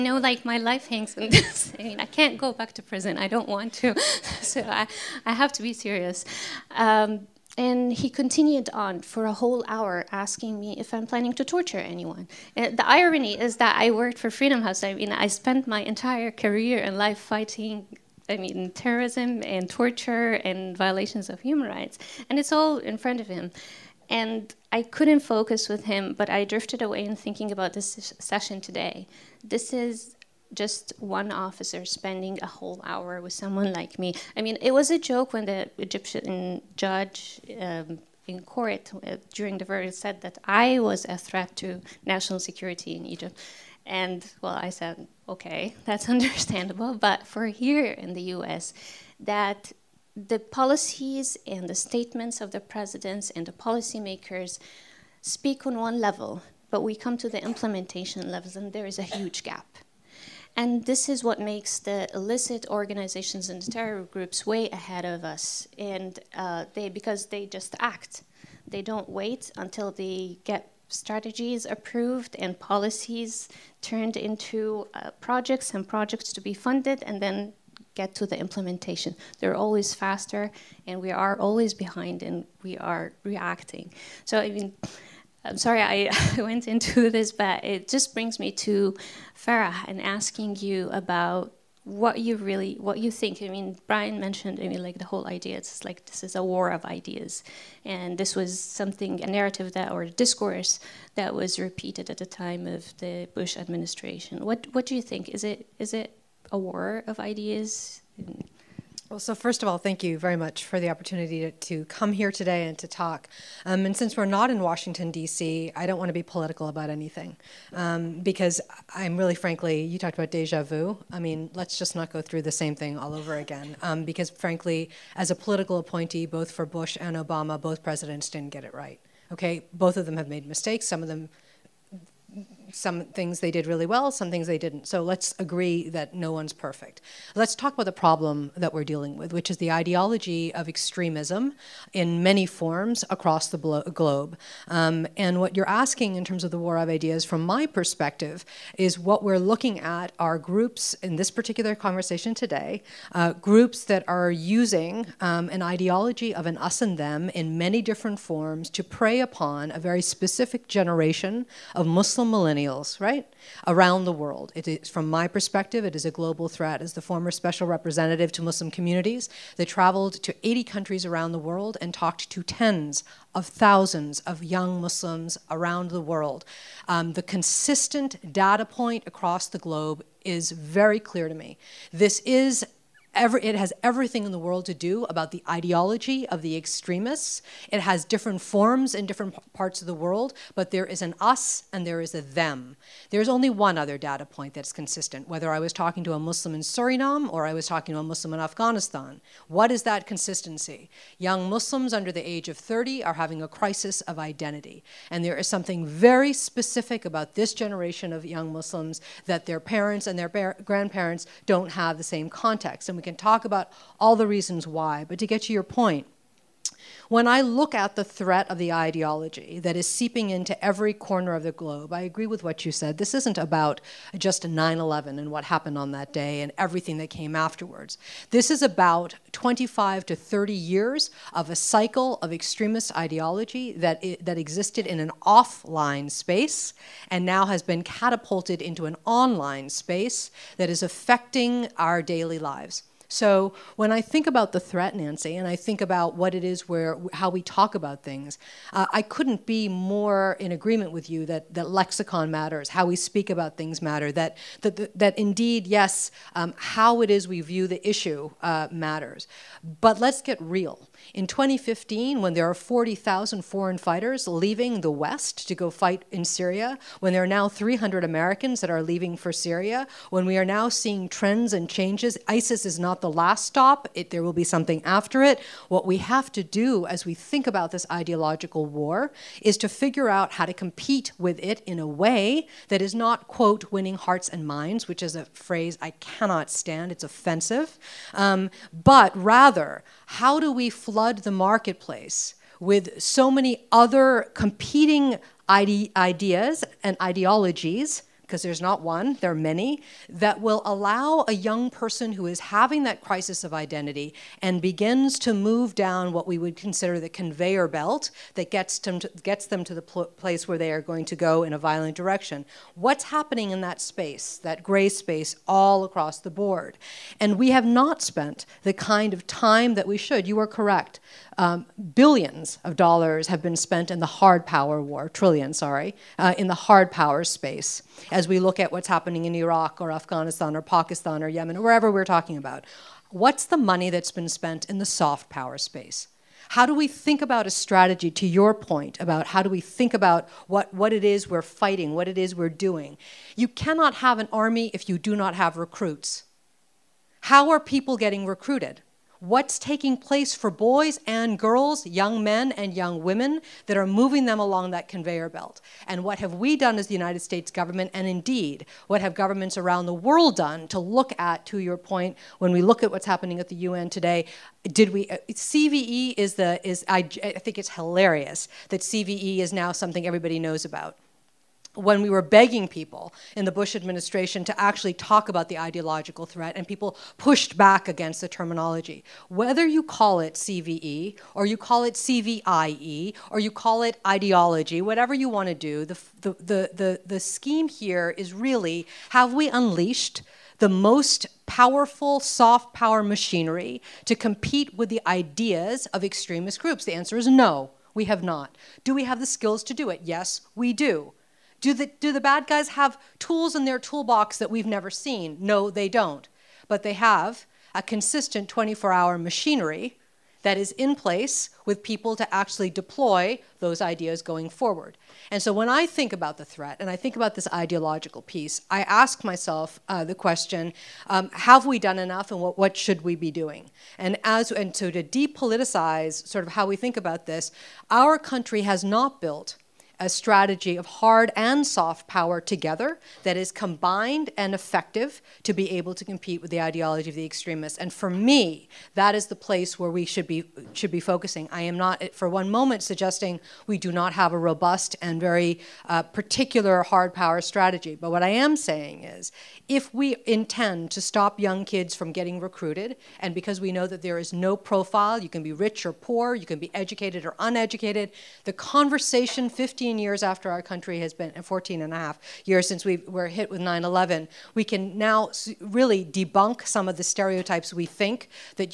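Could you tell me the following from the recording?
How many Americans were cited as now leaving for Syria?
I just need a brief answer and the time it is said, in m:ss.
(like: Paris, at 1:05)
300, at 4:27.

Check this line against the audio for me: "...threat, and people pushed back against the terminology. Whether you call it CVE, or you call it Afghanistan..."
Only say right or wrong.
wrong.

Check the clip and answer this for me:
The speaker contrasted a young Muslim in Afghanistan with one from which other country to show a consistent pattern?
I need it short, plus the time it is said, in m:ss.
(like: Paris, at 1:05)
Suriname, at 3:16.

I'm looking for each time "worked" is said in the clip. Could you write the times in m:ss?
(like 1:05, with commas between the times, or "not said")
0:13.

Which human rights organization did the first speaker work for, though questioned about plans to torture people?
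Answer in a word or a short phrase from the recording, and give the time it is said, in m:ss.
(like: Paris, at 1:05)
Freedom House, at 0:14.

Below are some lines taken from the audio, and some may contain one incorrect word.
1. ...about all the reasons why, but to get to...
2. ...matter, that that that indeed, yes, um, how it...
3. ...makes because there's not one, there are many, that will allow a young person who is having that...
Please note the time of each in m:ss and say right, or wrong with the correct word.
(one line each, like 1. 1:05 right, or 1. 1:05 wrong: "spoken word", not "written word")
1. 3:33 right
2. 4:13 right
3. 4:57 wrong: "ideologies", not "makes".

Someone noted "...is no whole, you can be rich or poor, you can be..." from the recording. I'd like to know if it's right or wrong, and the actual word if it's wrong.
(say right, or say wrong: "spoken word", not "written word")
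wrong: "profile", not "whole".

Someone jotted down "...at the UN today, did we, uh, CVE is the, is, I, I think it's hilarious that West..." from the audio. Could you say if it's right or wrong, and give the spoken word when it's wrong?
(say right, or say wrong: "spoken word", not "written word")
wrong: "CVE", not "West".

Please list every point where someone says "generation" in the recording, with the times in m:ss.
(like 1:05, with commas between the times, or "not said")
2:40, 3:27.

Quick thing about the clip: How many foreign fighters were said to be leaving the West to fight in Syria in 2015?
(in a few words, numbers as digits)
40,000.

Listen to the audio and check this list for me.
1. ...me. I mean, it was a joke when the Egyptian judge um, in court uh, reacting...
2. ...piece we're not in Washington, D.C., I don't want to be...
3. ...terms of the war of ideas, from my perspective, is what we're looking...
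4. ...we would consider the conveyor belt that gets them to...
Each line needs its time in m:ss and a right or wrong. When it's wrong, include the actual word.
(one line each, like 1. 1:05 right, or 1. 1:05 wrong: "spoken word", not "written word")
1. 0:33 wrong: "during", not "reacting"
2. 1:53 wrong: "since", not "piece"
3. 2:26 right
4. 5:06 right.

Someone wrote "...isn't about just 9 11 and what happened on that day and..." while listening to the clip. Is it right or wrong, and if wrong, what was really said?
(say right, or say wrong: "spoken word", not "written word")
right.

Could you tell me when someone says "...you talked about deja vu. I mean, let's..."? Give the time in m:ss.
1:59.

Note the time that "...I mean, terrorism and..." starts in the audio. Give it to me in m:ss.
0:18.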